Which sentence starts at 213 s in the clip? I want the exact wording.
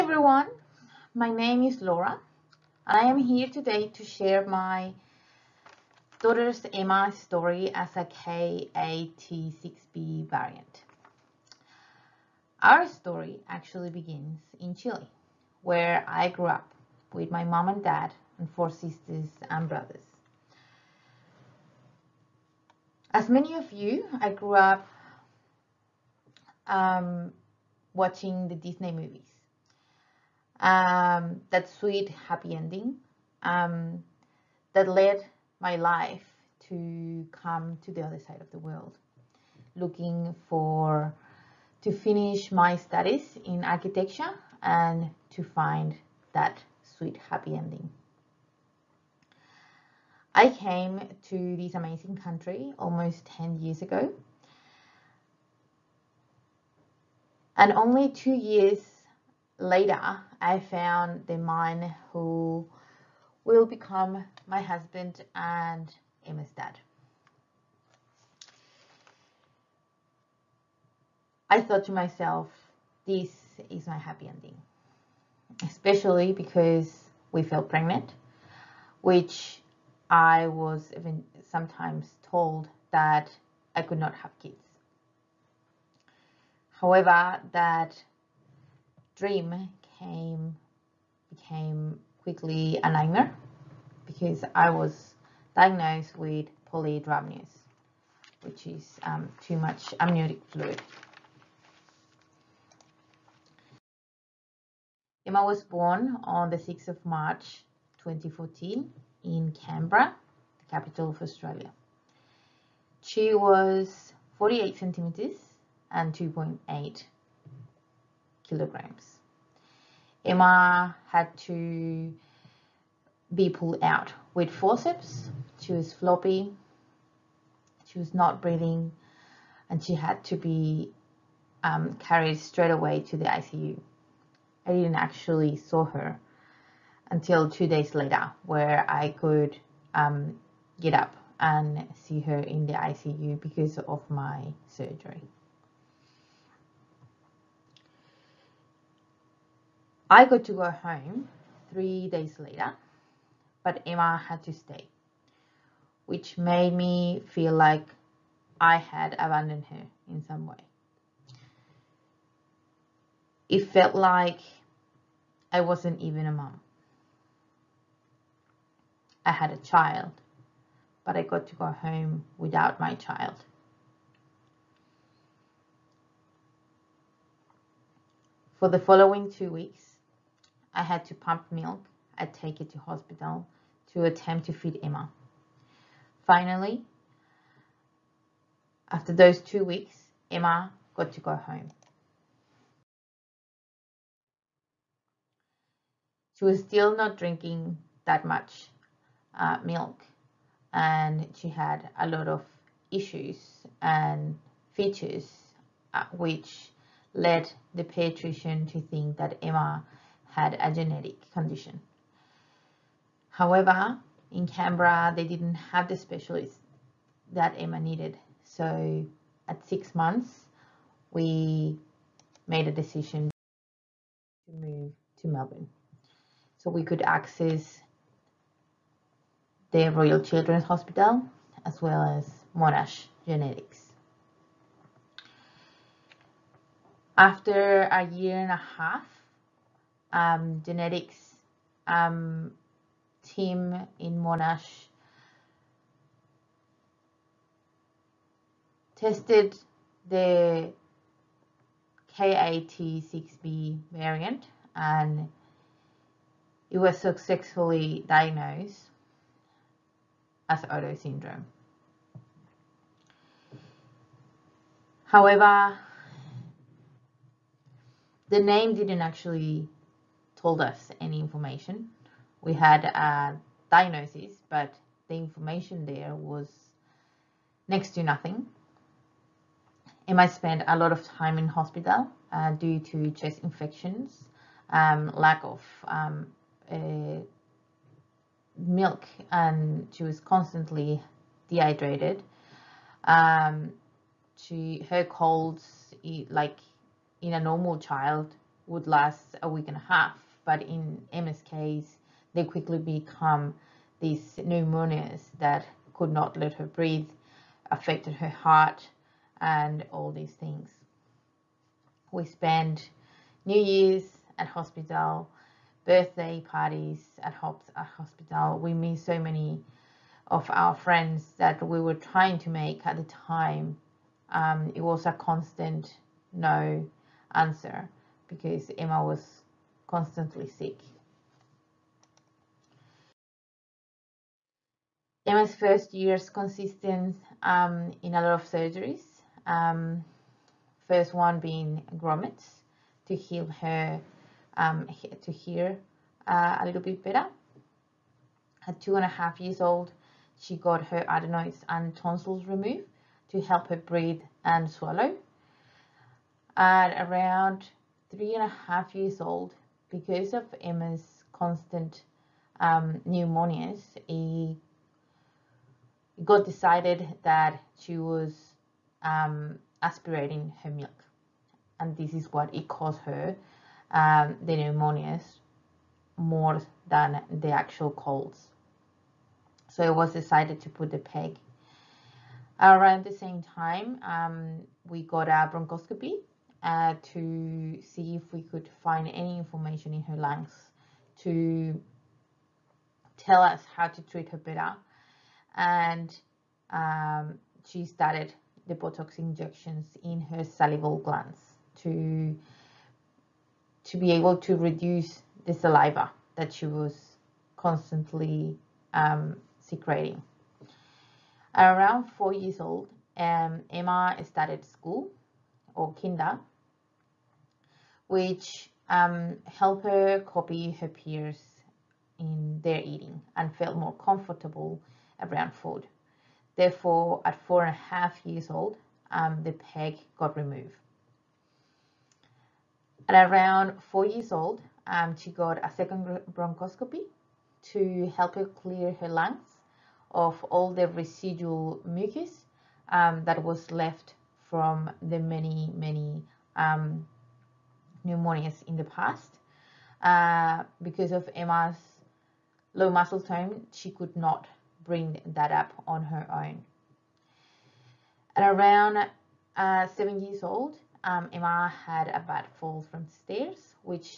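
However, in Canberra, they didn't have the specialist that Emma needed.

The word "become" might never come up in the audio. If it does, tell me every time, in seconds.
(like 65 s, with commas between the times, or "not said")
63 s, 302 s.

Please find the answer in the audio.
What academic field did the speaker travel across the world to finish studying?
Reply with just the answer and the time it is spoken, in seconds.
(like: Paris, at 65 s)
Architecture, at 43 s.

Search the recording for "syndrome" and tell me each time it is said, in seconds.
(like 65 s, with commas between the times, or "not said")
260 s.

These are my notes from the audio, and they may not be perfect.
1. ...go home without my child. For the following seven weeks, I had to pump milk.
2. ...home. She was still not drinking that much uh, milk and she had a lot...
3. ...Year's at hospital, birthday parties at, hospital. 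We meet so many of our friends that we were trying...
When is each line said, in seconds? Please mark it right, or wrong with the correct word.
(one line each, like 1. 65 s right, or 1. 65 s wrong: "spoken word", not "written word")
1. 171 s wrong: "two", not "seven"
2. 191 s right
3. 313 s right.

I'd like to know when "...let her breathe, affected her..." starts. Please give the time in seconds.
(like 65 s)
306 s.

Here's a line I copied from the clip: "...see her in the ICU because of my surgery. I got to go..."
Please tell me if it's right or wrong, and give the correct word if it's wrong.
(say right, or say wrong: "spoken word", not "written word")
right.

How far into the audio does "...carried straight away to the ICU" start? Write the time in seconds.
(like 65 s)
131 s.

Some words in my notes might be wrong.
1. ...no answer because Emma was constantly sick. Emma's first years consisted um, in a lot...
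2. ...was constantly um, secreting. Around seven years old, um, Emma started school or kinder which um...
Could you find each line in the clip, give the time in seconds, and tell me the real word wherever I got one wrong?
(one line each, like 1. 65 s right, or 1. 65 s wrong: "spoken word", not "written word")
1. 326 s right
2. 406 s wrong: "four", not "seven".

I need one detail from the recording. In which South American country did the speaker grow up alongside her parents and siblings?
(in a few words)
Chile.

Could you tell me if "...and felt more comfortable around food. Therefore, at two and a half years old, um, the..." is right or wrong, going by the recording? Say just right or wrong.
wrong.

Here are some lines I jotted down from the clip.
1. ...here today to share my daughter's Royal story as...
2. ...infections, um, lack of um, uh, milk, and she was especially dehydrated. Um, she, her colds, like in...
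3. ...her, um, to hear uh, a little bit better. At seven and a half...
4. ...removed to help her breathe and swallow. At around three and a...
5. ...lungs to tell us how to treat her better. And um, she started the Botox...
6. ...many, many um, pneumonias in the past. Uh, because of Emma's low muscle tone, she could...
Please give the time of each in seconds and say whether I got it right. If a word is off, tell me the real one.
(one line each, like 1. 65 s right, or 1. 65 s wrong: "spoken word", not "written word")
1. 3 s wrong: "Emma", not "Royal"
2. 283 s wrong: "constantly", not "especially"
3. 343 s wrong: "two", not "seven"
4. 352 s right
5. 390 s right
6. 445 s right.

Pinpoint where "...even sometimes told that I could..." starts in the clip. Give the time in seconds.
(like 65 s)
80 s.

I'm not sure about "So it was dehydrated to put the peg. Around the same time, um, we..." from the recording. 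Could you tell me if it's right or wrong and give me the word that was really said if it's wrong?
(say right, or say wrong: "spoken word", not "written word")
wrong: "decided", not "dehydrated".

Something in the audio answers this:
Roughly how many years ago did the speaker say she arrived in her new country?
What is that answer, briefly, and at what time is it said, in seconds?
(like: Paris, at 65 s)
10, at 53 s.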